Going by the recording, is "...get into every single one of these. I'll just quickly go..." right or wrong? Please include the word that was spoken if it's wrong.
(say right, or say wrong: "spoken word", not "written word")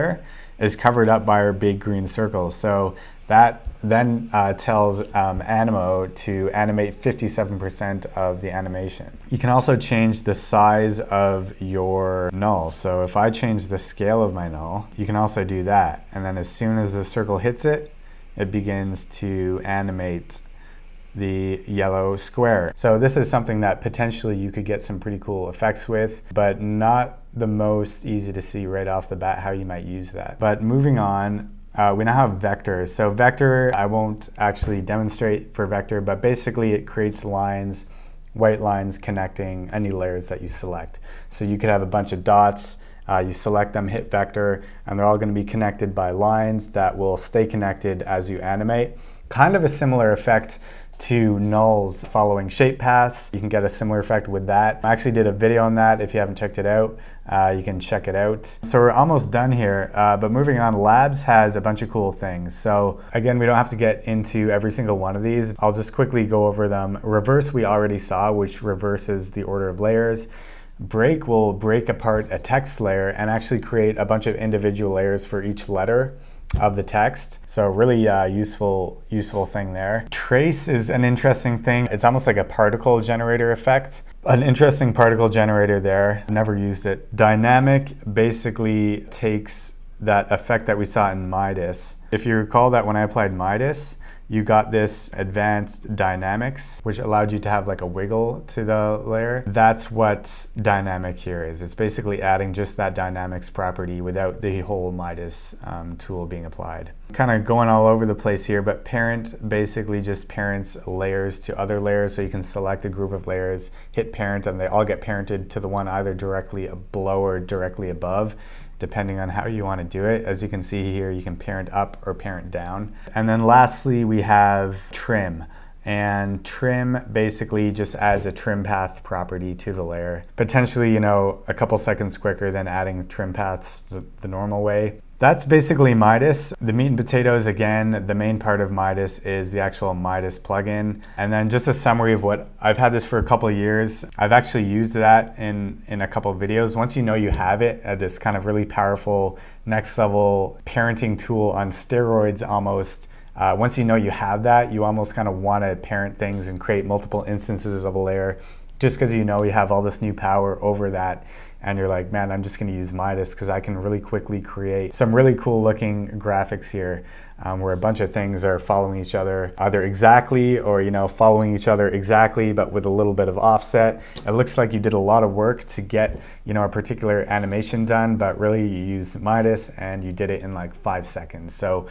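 right.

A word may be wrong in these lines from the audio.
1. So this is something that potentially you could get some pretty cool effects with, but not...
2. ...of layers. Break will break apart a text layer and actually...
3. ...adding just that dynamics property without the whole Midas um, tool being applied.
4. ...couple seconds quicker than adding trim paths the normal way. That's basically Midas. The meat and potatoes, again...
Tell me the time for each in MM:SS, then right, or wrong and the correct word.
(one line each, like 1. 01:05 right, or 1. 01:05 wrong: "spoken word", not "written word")
1. 00:22 right
2. 01:09 right
3. 01:42 right
4. 02:11 right.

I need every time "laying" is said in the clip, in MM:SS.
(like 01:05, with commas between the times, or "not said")
not said.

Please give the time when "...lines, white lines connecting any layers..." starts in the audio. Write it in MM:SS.
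00:37.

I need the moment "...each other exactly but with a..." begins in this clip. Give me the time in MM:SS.
02:51.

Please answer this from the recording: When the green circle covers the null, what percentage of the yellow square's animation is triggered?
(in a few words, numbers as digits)
57%.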